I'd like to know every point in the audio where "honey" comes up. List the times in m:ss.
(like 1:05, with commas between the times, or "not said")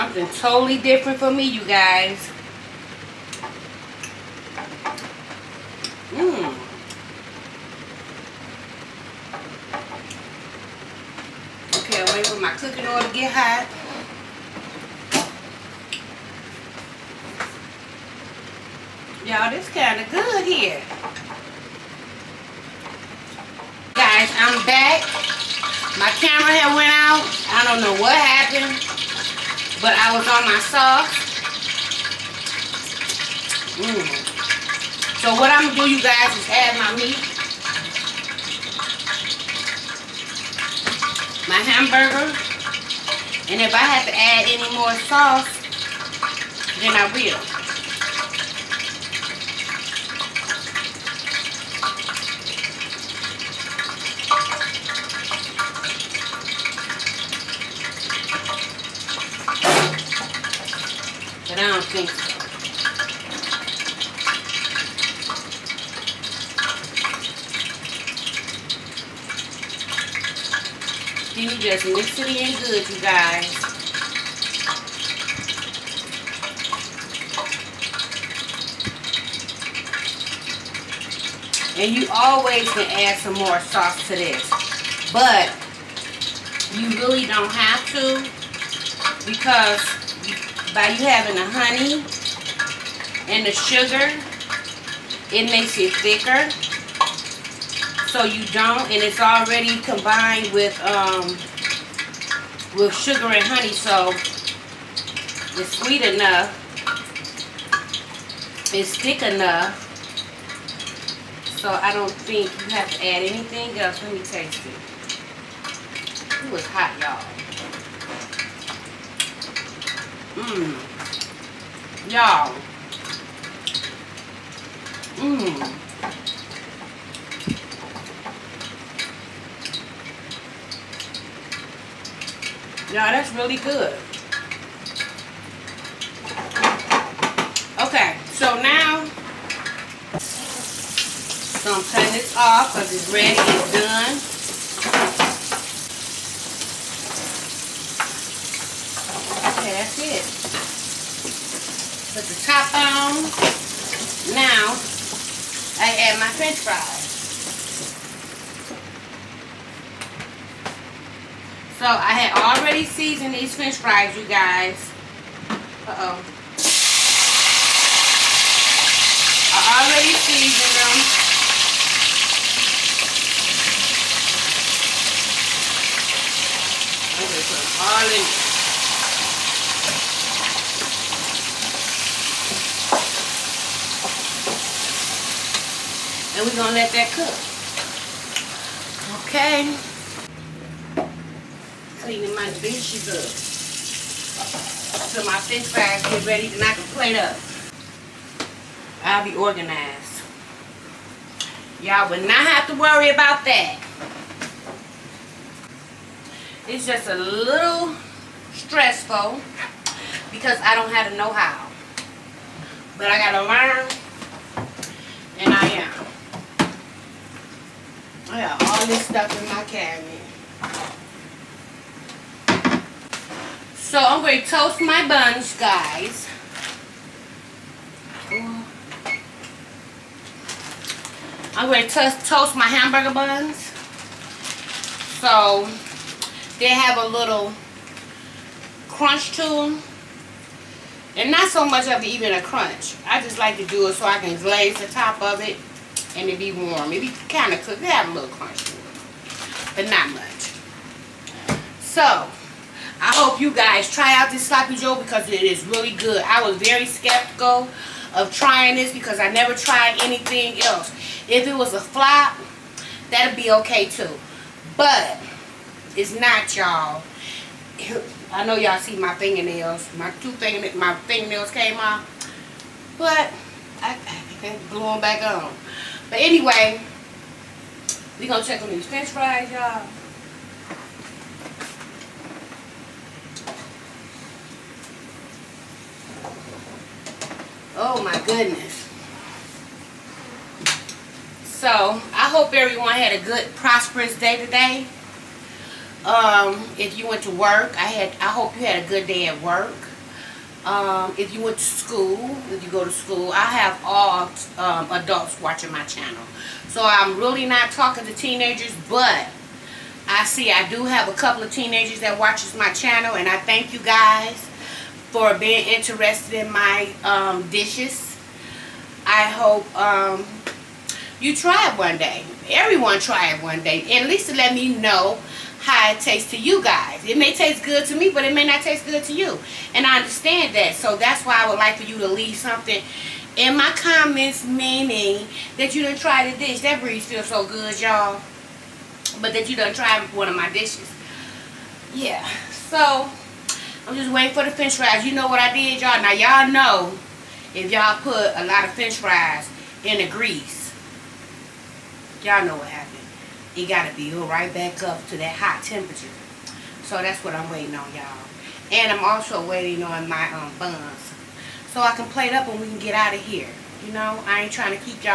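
1:31, 1:43.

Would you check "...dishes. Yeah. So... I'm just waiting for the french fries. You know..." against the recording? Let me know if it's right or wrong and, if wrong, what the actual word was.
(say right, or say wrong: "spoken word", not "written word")
right.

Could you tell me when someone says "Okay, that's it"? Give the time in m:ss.
2:29.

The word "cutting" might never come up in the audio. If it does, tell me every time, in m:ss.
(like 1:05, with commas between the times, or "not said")
2:21.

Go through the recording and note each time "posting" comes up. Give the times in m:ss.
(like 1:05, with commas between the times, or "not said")
not said.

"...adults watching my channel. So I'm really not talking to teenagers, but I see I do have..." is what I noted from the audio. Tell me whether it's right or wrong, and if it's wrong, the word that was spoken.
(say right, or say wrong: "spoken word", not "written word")
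right.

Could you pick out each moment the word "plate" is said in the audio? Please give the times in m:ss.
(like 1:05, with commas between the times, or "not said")
3:16, 6:02.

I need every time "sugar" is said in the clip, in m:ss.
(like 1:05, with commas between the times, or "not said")
1:33, 1:42.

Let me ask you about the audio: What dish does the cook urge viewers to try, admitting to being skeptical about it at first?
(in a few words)
sloppy joe.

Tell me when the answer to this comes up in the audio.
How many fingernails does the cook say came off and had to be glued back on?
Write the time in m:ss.
4:30.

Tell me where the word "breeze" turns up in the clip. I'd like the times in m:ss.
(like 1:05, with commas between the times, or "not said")
5:36.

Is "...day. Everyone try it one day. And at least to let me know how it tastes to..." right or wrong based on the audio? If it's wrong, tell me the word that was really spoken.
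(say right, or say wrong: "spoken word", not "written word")
right.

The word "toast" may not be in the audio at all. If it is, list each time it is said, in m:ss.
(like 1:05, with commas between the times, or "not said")
3:44, 3:52.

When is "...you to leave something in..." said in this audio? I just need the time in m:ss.
5:31.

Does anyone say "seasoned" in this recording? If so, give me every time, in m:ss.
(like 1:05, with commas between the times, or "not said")
2:42, 2:50.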